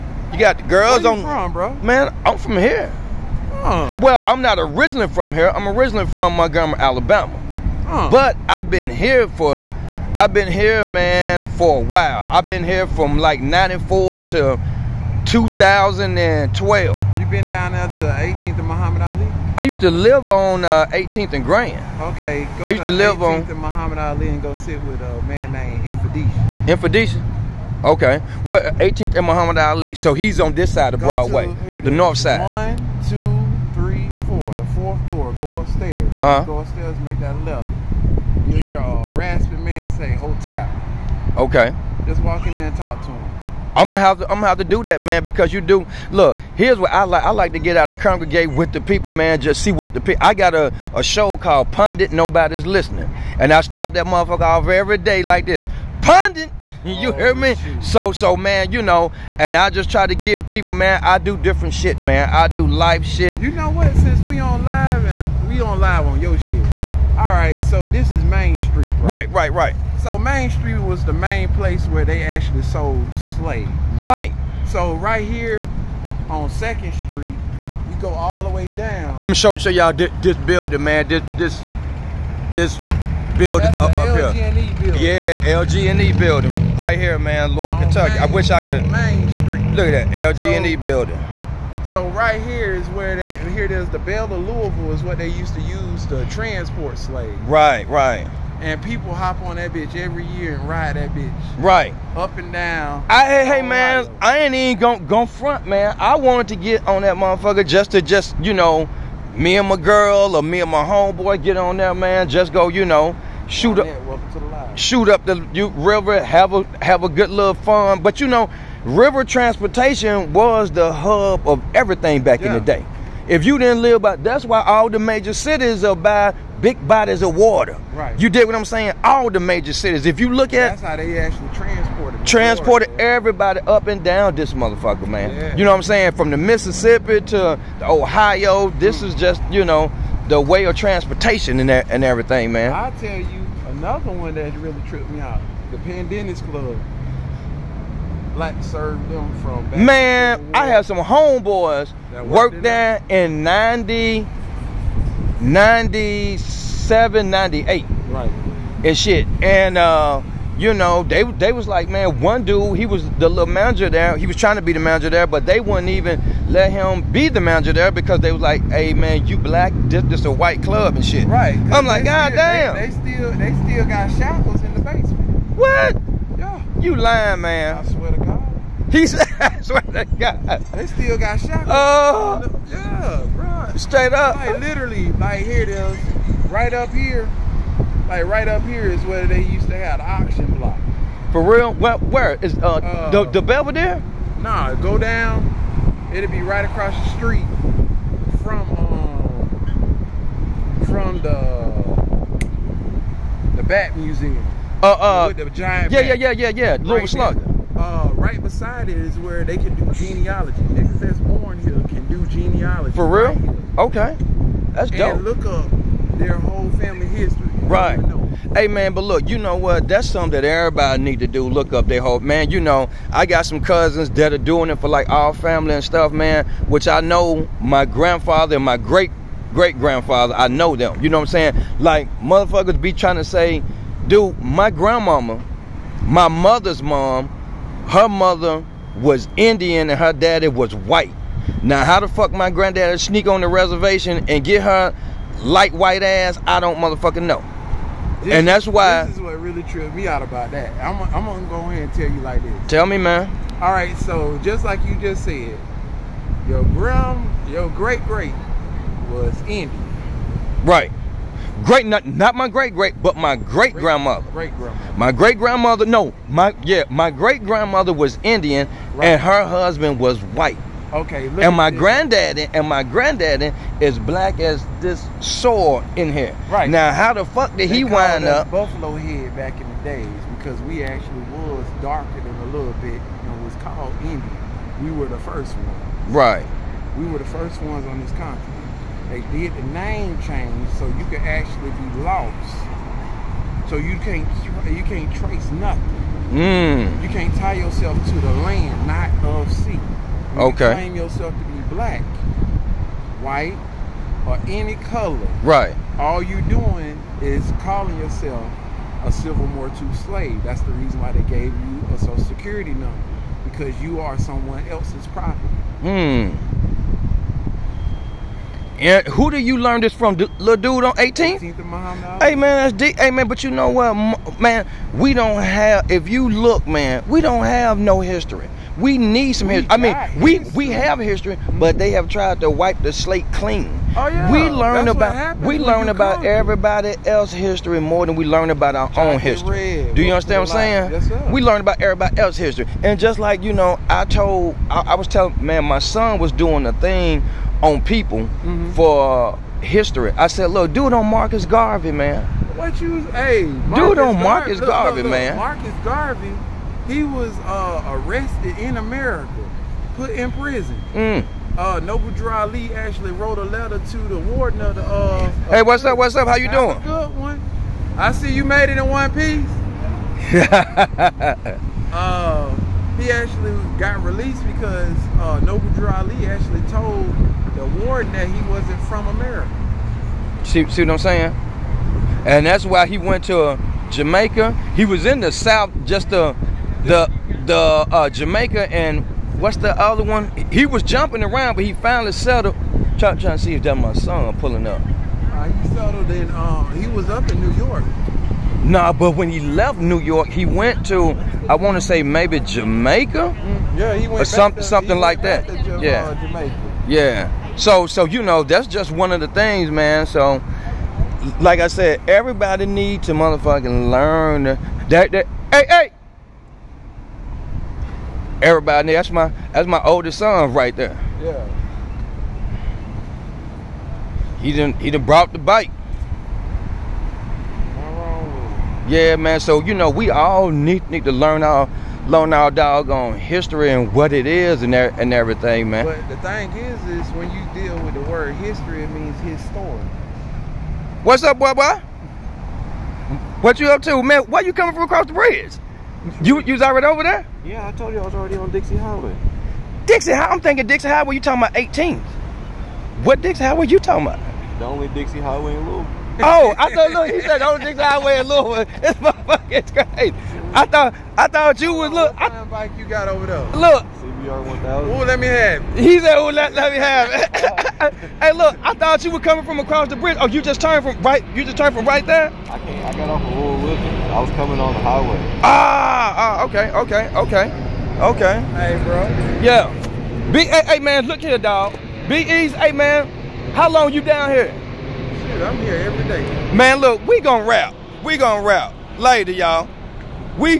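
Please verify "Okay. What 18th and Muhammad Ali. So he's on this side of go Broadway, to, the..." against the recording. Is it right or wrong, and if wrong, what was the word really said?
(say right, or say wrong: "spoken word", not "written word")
right.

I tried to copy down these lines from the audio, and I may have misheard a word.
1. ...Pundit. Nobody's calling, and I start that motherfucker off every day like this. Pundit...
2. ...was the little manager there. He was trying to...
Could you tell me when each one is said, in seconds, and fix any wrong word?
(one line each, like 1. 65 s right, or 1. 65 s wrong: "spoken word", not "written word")
1. 51 s wrong: "listening", not "calling"
2. 162 s right.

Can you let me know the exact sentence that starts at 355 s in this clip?
Marcus Garvey, he was uh, arrested in America, put in prison.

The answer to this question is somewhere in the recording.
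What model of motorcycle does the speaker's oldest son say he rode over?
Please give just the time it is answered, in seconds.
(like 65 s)
463 s.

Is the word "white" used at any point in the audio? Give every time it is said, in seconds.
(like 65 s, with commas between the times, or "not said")
170 s, 240 s, 245 s, 270 s, 303 s.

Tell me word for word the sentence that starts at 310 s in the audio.
That's the reason why they gave you a Social Security number because you are someone else's property.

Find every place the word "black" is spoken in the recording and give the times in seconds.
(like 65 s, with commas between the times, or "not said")
148 s, 169 s, 274 s, 301 s.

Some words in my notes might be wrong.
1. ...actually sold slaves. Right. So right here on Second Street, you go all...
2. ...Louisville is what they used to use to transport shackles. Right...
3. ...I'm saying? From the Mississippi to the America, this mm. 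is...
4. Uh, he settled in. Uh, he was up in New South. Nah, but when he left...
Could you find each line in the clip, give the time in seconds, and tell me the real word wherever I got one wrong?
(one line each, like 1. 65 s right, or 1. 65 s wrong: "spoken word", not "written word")
1. 72 s right
2. 94 s wrong: "slaves", not "shackles"
3. 135 s wrong: "Ohio", not "America"
4. 395 s wrong: "York", not "South".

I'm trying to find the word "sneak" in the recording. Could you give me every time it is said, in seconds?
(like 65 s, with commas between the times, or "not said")
242 s.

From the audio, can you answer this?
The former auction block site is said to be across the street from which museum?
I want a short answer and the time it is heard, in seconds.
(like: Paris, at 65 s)
Bat Museum, at 203 s.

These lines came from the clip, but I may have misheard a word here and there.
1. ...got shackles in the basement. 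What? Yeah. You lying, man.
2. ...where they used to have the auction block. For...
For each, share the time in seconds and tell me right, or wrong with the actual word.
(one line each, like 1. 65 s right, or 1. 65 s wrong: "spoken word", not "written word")
1. 173 s right
2. 189 s right.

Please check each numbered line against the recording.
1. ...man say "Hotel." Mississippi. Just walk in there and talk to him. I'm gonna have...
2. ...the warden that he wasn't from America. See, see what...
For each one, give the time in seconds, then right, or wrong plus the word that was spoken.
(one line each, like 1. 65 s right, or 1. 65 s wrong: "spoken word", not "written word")
1. 39 s wrong: "Okay", not "Mississippi"
2. 377 s right.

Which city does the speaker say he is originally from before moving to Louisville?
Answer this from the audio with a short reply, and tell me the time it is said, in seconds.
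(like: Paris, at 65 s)
Montgomery, Alabama, at 6 s.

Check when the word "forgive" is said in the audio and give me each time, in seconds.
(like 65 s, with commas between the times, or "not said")
not said.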